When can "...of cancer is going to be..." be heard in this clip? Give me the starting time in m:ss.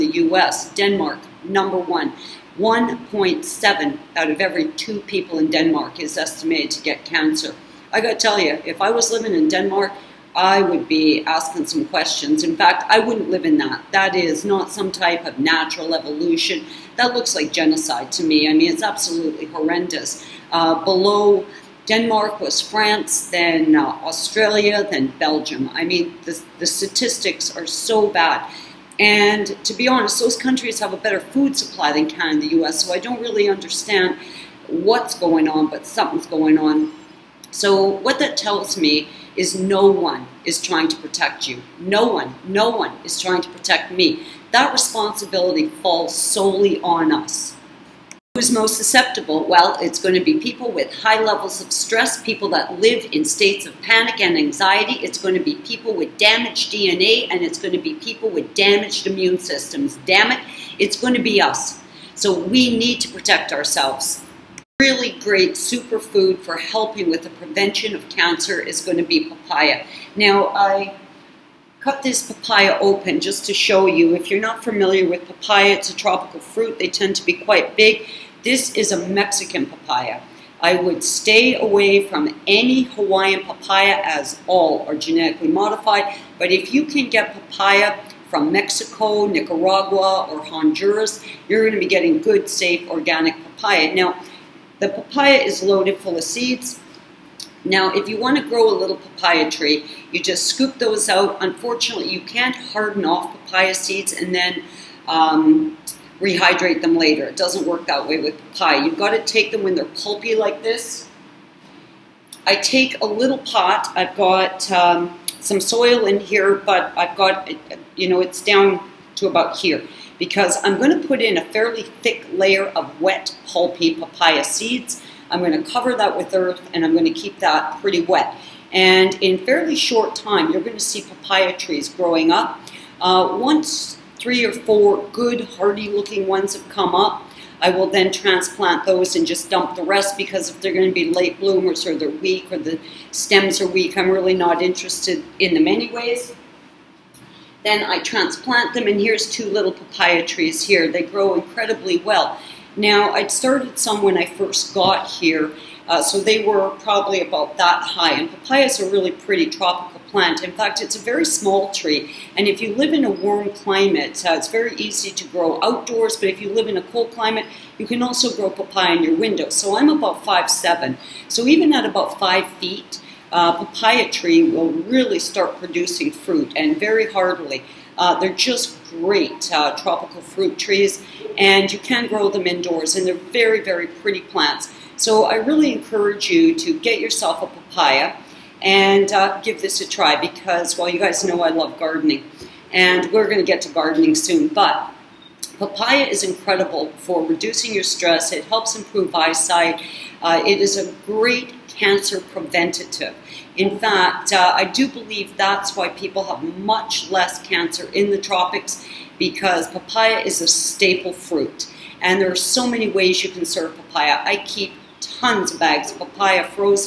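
1:07.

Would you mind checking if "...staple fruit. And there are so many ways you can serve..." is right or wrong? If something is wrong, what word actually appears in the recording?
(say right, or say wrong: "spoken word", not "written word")
right.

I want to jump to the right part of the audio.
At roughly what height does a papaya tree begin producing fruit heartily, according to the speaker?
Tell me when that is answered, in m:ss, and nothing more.
2:52.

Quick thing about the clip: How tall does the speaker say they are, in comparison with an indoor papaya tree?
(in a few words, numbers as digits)
5 foot 7.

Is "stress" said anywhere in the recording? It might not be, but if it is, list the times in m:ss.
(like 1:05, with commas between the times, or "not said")
0:51, 3:17.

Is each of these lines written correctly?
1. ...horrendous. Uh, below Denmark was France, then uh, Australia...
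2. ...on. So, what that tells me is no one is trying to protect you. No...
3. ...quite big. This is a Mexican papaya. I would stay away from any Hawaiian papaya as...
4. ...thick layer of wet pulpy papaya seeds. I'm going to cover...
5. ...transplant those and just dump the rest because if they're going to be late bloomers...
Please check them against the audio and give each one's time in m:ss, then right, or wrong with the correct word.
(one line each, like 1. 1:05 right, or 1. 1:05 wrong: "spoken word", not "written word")
1. 0:19 right
2. 0:36 right
3. 1:17 right
4. 2:02 right
5. 2:18 right.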